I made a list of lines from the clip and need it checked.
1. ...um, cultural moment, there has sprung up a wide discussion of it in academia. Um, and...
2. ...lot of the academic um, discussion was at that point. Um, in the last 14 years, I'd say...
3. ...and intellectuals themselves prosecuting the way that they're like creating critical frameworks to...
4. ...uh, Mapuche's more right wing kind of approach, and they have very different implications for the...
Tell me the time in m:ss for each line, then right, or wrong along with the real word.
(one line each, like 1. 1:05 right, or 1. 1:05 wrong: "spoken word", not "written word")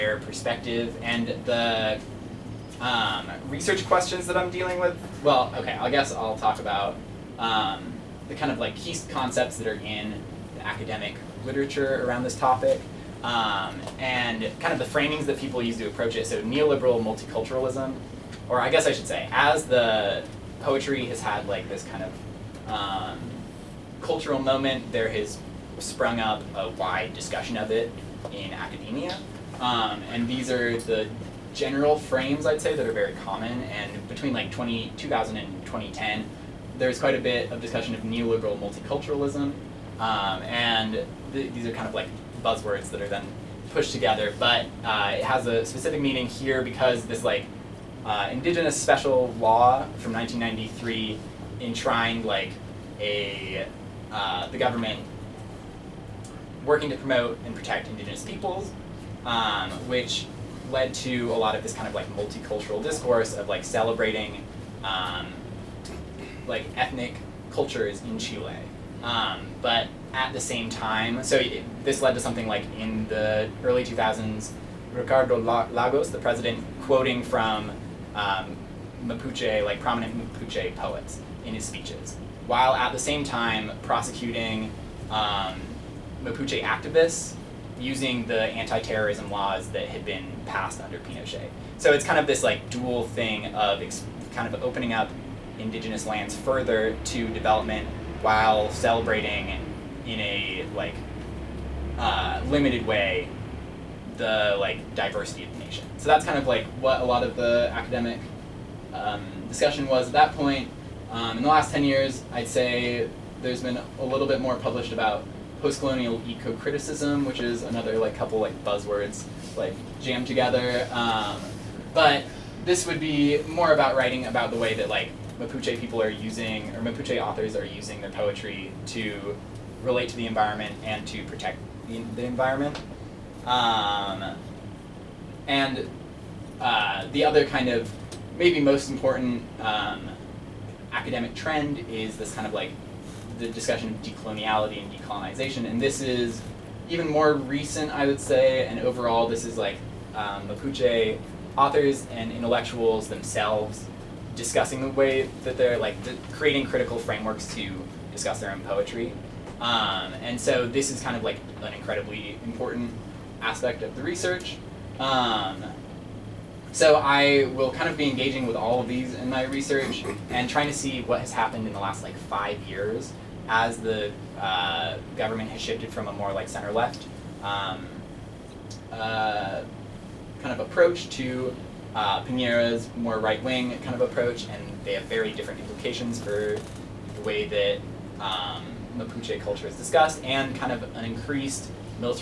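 1. 0:22 right
2. 1:47 wrong: "10", not "14"
3. 2:32 wrong: "discussing", not "prosecuting"
4. 3:01 wrong: "Pinera", not "Mapuche".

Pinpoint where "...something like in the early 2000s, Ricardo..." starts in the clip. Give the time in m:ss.
1:12.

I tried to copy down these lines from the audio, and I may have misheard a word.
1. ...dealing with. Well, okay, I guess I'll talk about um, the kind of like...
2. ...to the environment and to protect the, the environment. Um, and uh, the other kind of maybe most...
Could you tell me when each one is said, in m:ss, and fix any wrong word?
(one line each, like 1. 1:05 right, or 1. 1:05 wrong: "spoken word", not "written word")
1. 0:04 right
2. 2:10 right.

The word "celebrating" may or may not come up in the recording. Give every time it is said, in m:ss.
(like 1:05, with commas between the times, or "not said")
1:03, 1:38.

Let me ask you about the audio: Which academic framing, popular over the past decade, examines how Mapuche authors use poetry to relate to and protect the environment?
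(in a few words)
post-colonial eco-criticism.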